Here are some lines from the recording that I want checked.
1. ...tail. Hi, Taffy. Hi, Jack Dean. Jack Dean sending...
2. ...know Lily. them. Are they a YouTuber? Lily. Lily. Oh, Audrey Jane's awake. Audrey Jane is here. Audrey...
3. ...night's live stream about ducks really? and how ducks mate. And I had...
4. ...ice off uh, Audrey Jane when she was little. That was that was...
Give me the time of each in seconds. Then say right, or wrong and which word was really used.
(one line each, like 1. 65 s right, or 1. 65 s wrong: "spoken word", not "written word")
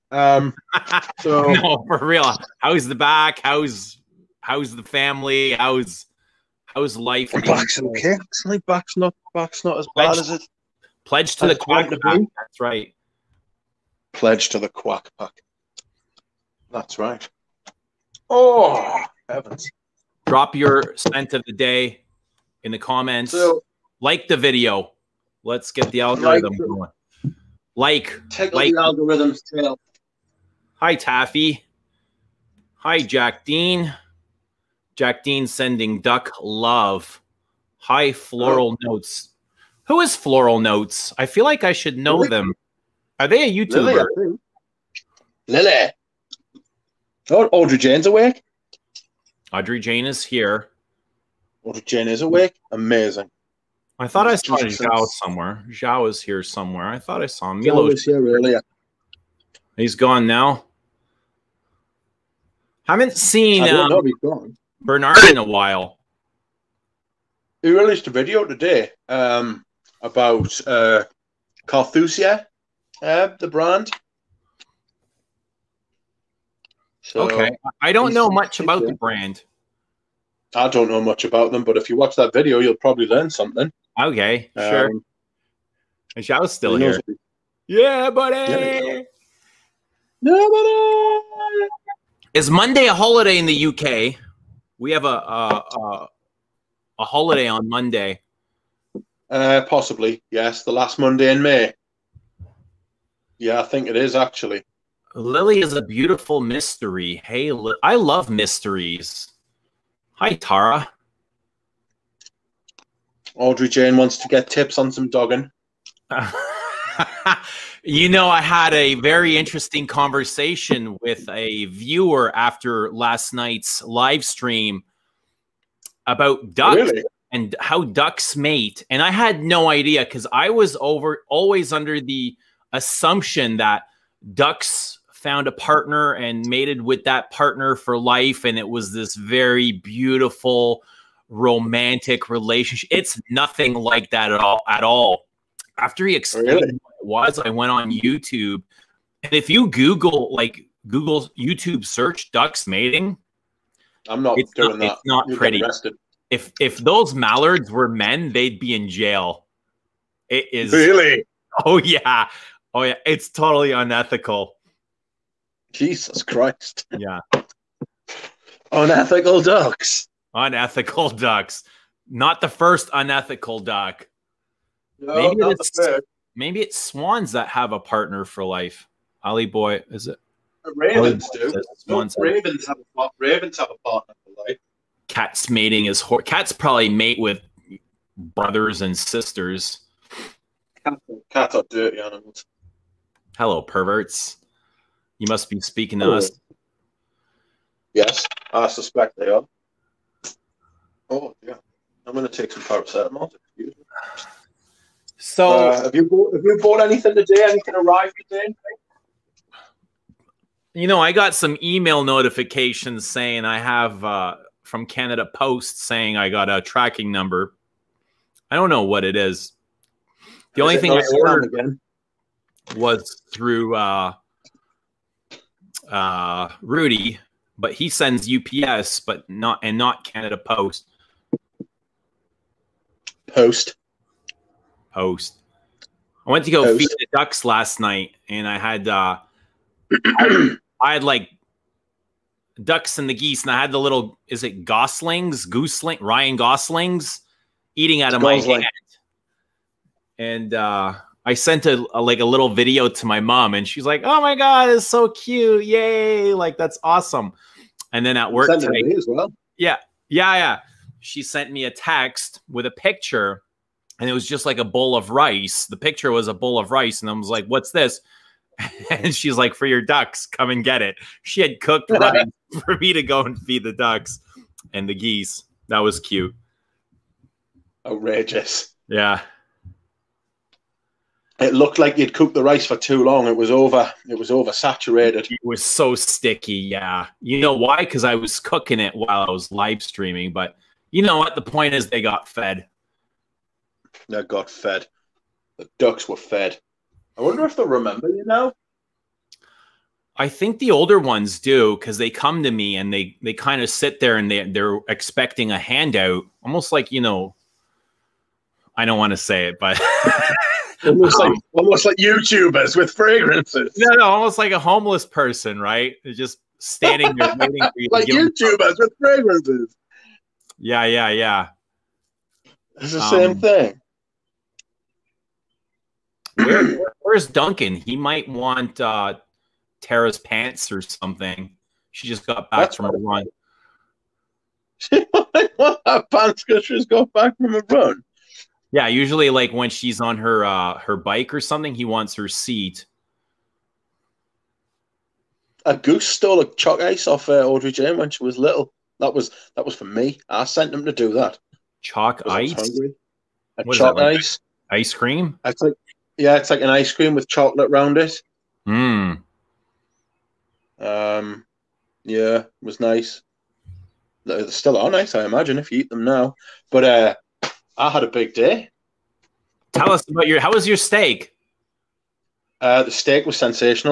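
1. 29 s right
2. 41 s right
3. 123 s right
4. 346 s right.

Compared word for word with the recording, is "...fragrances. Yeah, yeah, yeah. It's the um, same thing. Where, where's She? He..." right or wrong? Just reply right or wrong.
wrong.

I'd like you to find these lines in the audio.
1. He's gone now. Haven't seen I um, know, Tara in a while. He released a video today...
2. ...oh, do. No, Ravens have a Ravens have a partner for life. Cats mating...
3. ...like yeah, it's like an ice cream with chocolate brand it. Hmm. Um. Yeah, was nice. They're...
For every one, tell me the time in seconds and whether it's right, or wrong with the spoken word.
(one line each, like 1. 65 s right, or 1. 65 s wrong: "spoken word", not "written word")
1. 59 s wrong: "Bernard", not "Tara"
2. 181 s right
3. 355 s wrong: "round", not "brand".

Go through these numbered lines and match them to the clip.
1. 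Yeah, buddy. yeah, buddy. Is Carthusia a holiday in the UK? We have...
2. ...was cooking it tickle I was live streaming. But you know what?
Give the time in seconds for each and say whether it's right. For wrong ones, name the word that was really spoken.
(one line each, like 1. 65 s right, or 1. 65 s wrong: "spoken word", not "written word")
1. 87 s wrong: "Monday", not "Carthusia"
2. 288 s wrong: "while", not "tickle".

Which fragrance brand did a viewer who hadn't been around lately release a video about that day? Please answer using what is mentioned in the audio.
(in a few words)
Carthusia.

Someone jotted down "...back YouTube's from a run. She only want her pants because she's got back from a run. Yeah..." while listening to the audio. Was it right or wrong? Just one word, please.
wrong.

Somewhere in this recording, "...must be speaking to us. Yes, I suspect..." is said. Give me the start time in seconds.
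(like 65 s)
195 s.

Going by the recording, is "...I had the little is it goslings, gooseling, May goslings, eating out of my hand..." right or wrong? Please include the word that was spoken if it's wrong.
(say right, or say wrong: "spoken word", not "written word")
wrong: "Ryan", not "May".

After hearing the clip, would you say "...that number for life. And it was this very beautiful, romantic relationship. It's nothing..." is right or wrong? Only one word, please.
wrong.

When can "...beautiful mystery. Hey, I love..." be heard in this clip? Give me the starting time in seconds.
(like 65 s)
105 s.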